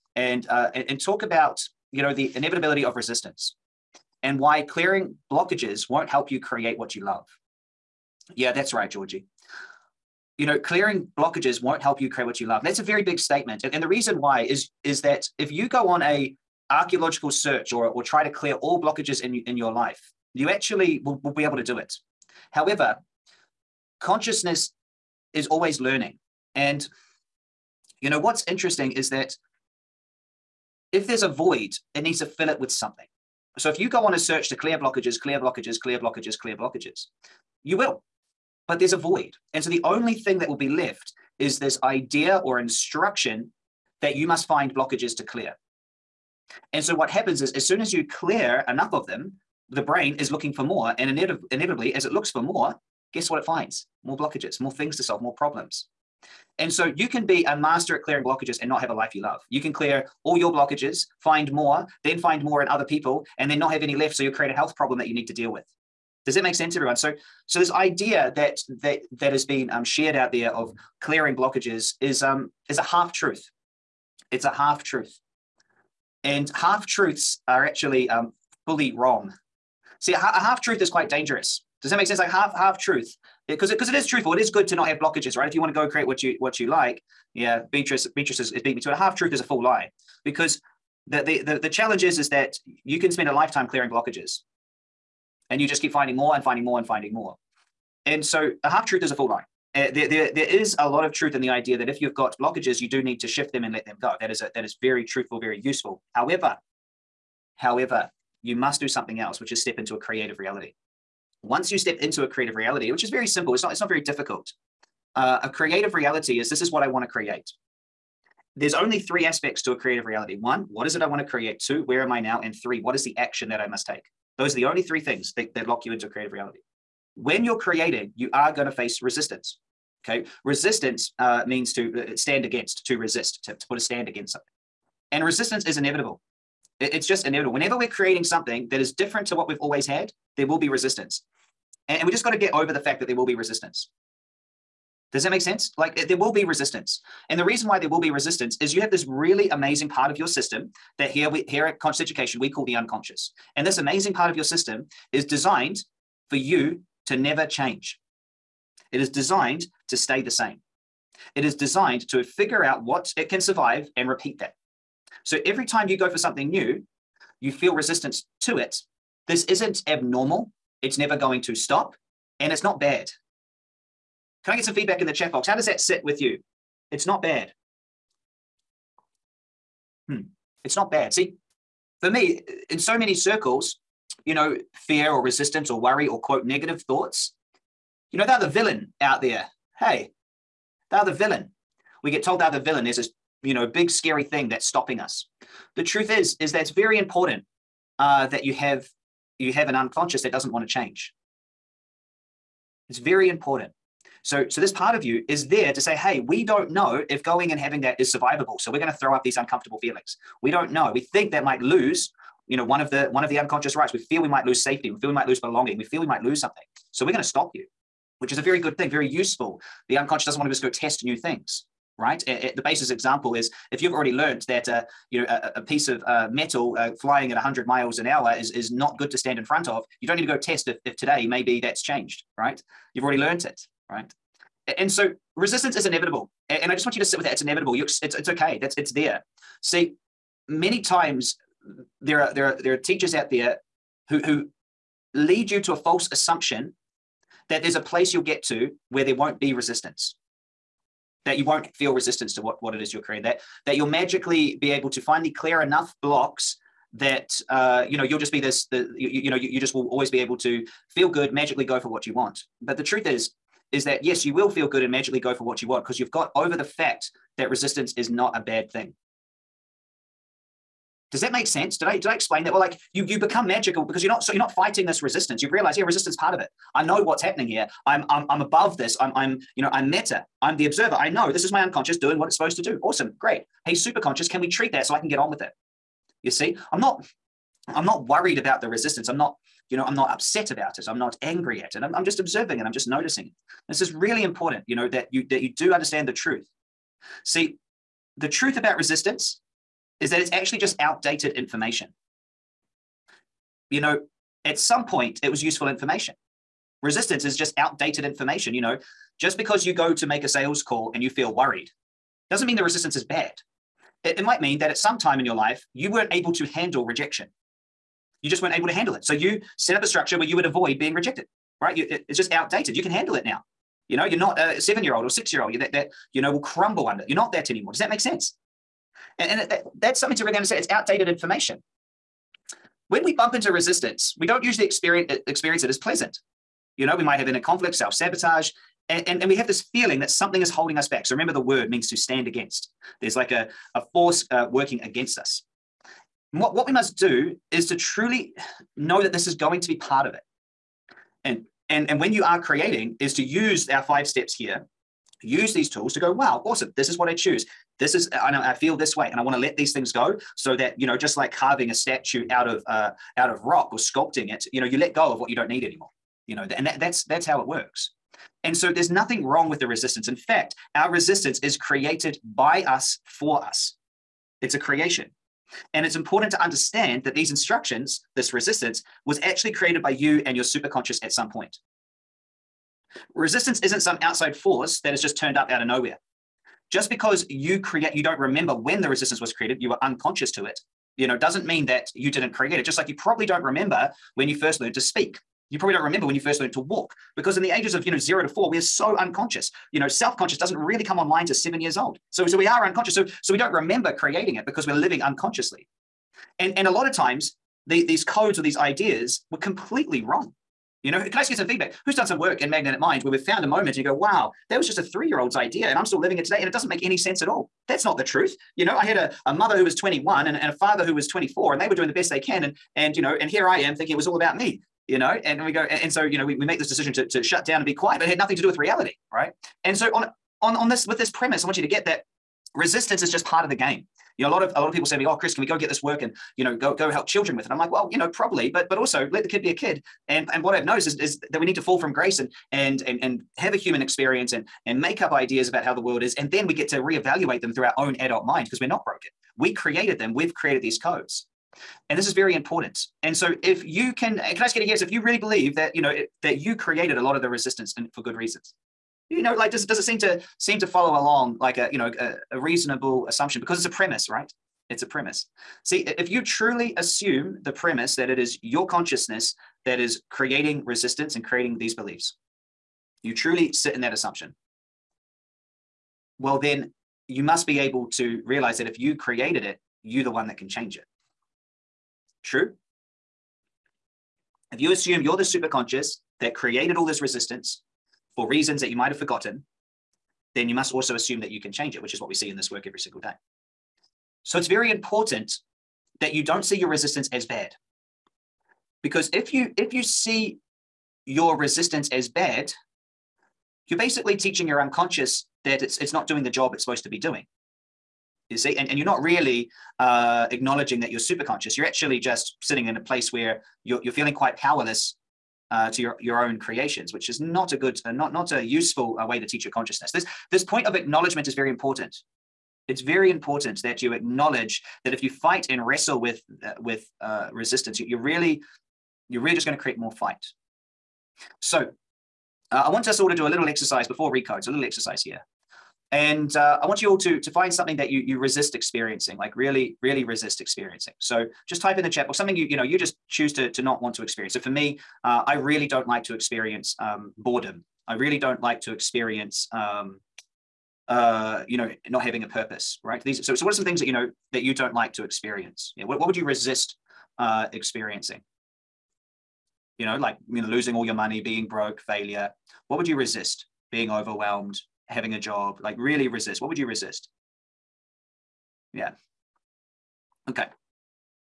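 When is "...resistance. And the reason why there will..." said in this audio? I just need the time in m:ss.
2:26.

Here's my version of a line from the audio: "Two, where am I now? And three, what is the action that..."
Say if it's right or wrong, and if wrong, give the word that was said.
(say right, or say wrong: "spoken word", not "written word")
right.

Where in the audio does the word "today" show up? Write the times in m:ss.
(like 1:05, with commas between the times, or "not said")
3:50, 6:56.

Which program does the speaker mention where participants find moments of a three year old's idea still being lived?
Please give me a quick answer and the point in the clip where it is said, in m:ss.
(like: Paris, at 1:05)
Magnetic Mind, at 6:52.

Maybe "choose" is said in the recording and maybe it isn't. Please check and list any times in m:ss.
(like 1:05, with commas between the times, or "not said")
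5:57, 9:03.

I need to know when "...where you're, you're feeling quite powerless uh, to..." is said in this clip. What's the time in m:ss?
8:33.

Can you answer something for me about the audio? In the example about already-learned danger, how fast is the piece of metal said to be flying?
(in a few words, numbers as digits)
100 miles an hour.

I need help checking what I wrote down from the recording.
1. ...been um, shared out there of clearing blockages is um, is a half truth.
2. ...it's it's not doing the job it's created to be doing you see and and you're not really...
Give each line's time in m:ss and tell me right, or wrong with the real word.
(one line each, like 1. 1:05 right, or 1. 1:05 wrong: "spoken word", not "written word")
1. 1:09 right
2. 8:25 wrong: "supposed", not "created".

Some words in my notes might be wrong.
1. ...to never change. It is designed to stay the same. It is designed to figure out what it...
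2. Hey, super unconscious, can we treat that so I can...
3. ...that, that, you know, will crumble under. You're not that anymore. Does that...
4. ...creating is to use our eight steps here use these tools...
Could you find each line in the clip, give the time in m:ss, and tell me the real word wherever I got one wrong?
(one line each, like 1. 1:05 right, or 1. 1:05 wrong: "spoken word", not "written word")
1. 2:37 right
2. 4:43 wrong: "conscious", not "unconscious"
3. 5:25 right
4. 5:52 wrong: "five", not "eight".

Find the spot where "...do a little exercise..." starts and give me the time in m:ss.
8:53.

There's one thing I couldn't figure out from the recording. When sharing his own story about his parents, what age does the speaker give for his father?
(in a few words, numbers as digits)
24.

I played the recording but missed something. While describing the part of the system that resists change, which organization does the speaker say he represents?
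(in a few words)
Conscious Education.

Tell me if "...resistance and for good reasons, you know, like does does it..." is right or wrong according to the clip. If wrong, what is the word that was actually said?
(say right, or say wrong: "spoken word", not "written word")
right.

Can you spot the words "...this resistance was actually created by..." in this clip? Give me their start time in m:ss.
6:18.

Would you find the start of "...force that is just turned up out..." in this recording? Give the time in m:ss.
6:24.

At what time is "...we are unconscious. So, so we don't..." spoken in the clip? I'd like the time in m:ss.
6:42.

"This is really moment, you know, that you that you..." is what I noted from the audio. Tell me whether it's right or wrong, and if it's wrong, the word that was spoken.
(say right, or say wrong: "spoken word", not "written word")
wrong: "important", not "moment".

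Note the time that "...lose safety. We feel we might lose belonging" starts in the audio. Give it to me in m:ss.
3:34.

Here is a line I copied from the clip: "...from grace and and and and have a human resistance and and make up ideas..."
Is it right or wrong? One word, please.
wrong.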